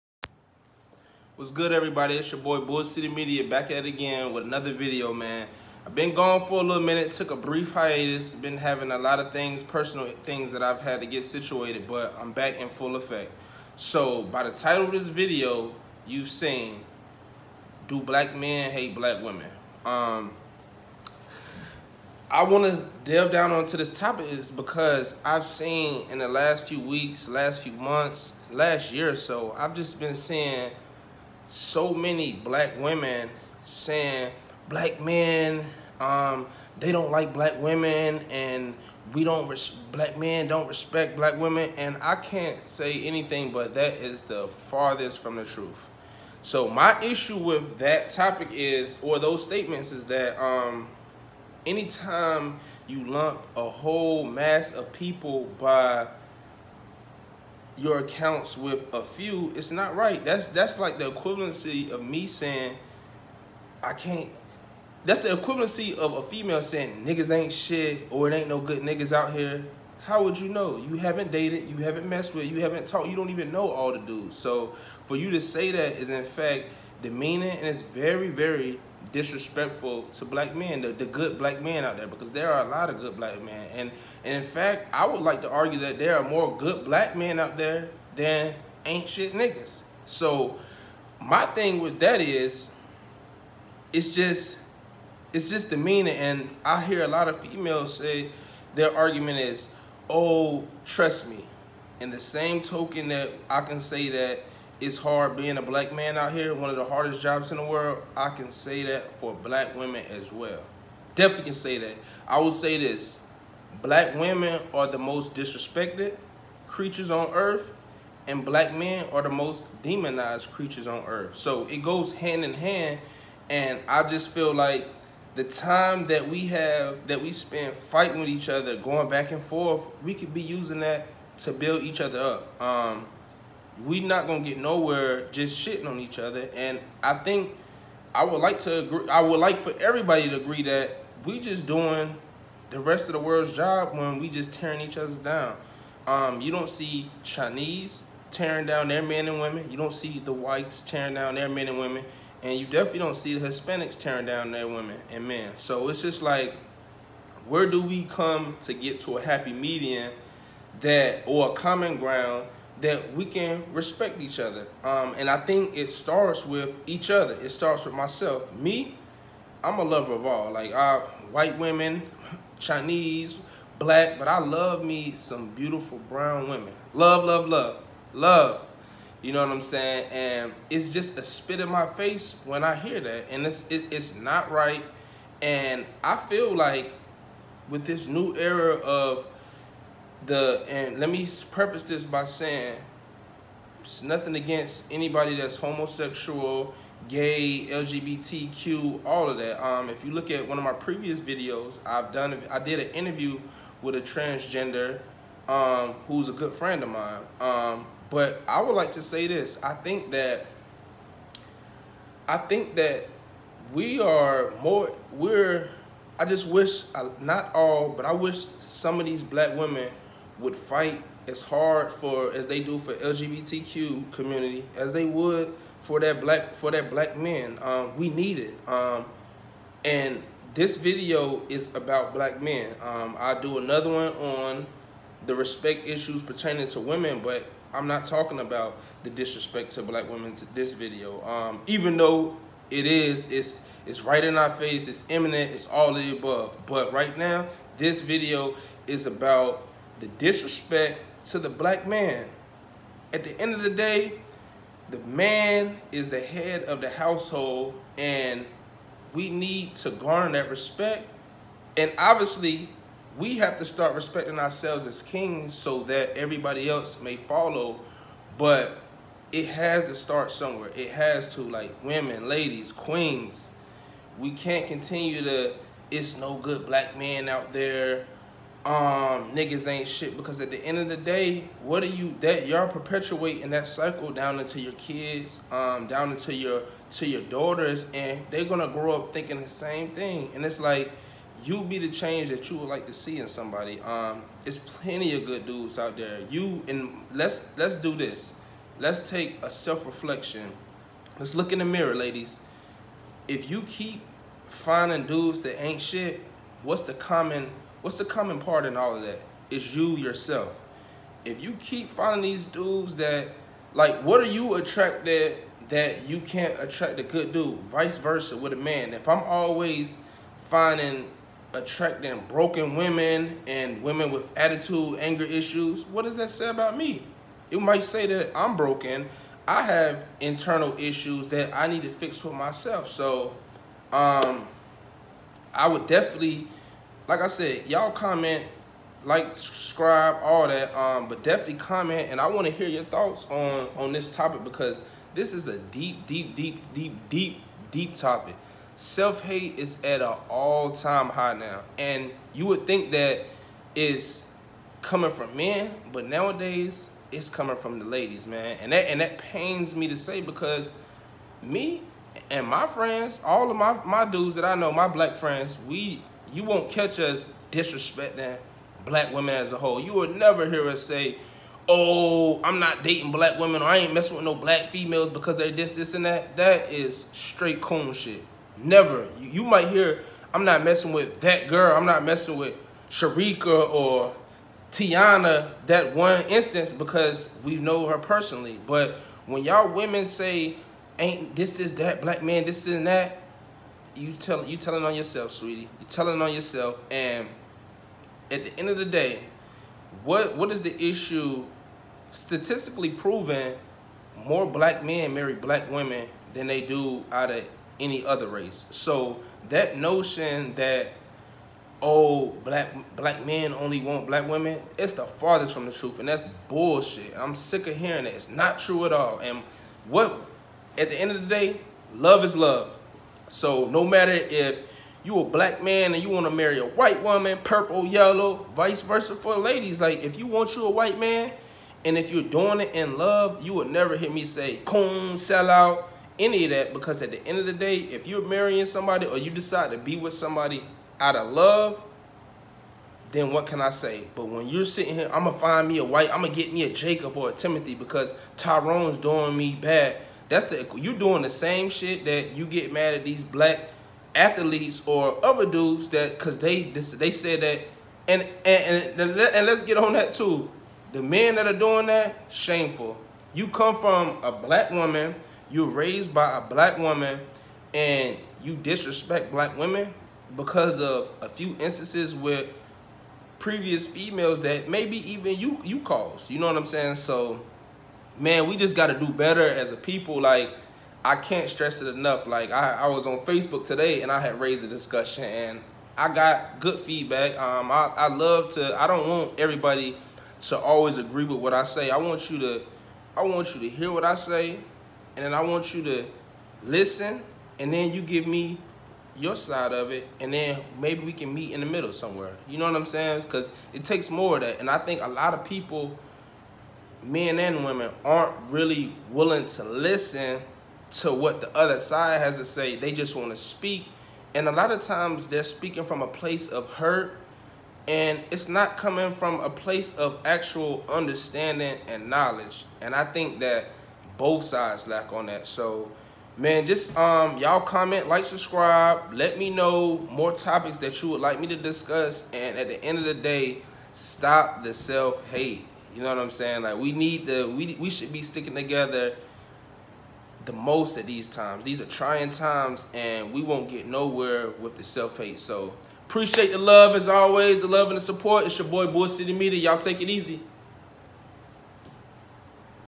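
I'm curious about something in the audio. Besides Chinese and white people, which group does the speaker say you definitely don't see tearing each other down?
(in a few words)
Hispanics.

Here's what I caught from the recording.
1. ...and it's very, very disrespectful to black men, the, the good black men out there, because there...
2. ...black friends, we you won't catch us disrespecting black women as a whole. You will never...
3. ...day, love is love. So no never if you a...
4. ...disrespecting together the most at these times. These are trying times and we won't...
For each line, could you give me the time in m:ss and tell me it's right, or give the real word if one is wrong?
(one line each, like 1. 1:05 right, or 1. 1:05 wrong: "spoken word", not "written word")
1. 1:17 right
2. 6:04 right
3. 7:01 wrong: "matter", not "never"
4. 8:58 wrong: "sticking", not "disrespecting".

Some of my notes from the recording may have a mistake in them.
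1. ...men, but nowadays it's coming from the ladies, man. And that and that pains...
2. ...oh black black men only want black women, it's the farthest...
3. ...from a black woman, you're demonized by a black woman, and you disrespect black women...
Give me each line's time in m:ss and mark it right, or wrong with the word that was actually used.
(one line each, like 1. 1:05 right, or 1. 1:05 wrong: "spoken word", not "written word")
1. 5:55 right
2. 6:51 right
3. 7:43 wrong: "raised", not "demonized".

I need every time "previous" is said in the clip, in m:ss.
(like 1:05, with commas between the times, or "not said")
3:20, 7:53.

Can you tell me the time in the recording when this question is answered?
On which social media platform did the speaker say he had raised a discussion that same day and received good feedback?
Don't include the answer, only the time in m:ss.
8:03.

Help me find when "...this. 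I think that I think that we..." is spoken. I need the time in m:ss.
3:29.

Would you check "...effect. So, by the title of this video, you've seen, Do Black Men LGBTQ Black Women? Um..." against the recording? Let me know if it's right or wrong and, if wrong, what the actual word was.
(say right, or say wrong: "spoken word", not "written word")
wrong: "Hate", not "LGBTQ".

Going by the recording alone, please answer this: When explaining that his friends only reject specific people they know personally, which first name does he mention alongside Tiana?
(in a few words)
Sharika.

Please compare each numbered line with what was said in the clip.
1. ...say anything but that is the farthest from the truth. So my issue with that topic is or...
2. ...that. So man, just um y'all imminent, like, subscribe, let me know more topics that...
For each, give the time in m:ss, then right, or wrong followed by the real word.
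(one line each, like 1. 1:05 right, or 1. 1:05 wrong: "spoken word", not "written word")
1. 0:42 right
2. 8:45 wrong: "comment", not "imminent".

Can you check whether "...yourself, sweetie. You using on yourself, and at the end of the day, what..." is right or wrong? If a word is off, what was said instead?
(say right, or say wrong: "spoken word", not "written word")
wrong: "telling", not "using".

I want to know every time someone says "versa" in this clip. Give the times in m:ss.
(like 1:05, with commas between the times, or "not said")
5:17, 7:08.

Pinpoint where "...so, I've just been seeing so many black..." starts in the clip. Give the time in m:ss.
0:29.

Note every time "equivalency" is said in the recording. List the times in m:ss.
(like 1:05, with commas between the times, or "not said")
1:01, 1:05.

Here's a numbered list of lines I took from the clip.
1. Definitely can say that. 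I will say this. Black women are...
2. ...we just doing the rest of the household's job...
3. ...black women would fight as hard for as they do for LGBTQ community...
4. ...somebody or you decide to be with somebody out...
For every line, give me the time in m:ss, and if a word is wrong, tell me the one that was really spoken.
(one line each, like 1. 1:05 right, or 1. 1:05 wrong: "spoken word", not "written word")
1. 1:51 right
2. 2:21 wrong: "world", not "household"
3. 3:39 right
4. 7:18 right.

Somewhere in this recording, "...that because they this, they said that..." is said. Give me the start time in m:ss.
7:35.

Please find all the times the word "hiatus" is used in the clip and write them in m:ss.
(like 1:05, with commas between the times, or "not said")
0:07.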